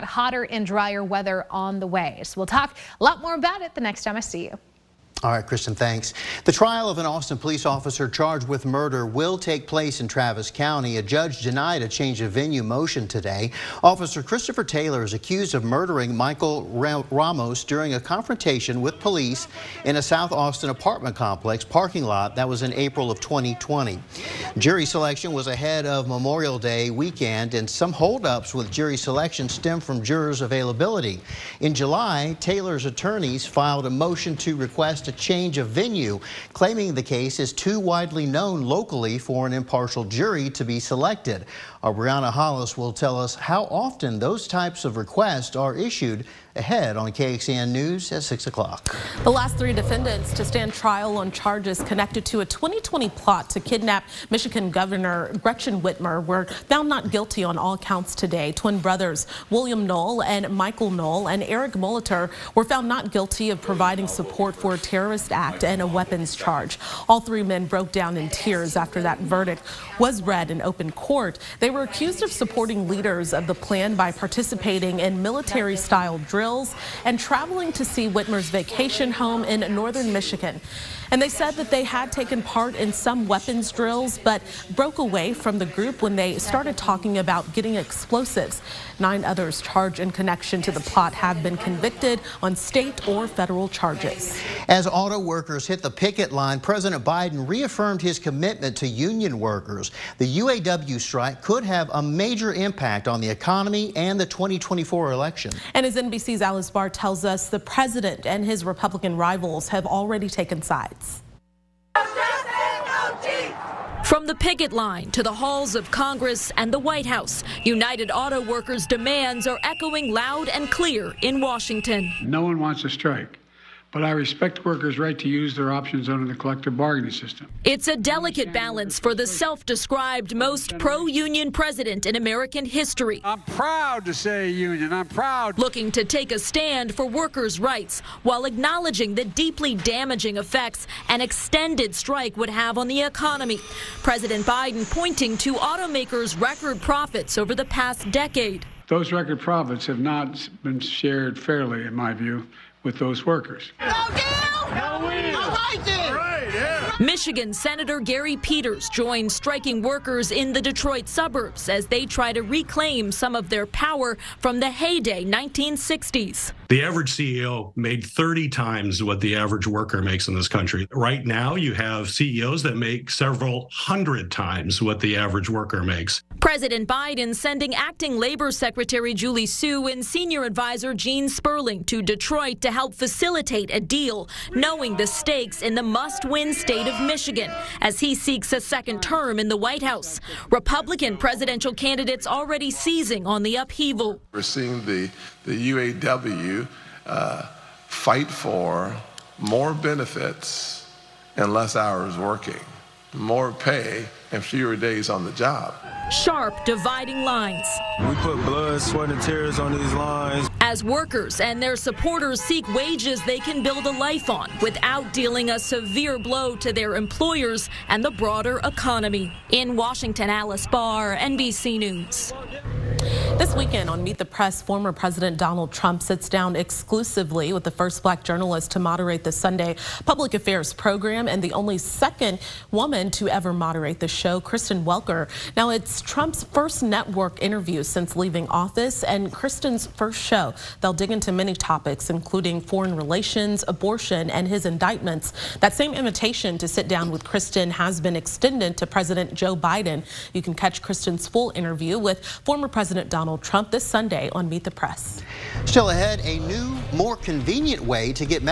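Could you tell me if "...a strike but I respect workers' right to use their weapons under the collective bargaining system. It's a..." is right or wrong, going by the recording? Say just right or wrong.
wrong.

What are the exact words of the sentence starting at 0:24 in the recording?
Jury selection was ahead of Memorial Day weekend, and some holdups with jury selection stem from jurors' availability.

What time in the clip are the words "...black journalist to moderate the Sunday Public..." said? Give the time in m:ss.
3:48.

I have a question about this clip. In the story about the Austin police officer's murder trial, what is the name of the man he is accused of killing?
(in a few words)
Michael Ramos.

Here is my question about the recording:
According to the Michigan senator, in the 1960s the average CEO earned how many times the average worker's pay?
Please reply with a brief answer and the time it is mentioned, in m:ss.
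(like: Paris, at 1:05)
30, at 2:48.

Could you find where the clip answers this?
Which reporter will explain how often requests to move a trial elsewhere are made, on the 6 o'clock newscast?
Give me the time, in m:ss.
0:41.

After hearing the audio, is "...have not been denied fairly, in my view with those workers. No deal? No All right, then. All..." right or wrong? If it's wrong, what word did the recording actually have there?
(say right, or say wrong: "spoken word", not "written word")
wrong: "shared", not "denied".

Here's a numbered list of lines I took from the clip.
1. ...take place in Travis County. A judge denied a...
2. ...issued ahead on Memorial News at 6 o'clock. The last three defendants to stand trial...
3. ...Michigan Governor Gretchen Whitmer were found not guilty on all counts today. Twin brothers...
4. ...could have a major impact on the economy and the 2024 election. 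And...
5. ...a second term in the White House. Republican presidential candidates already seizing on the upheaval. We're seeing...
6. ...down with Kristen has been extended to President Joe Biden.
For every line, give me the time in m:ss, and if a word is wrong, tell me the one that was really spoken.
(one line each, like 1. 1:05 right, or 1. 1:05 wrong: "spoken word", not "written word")
1. 0:09 right
2. 0:45 wrong: "KXAN", not "Memorial"
3. 0:54 right
4. 1:41 right
5. 3:08 right
6. 4:06 right.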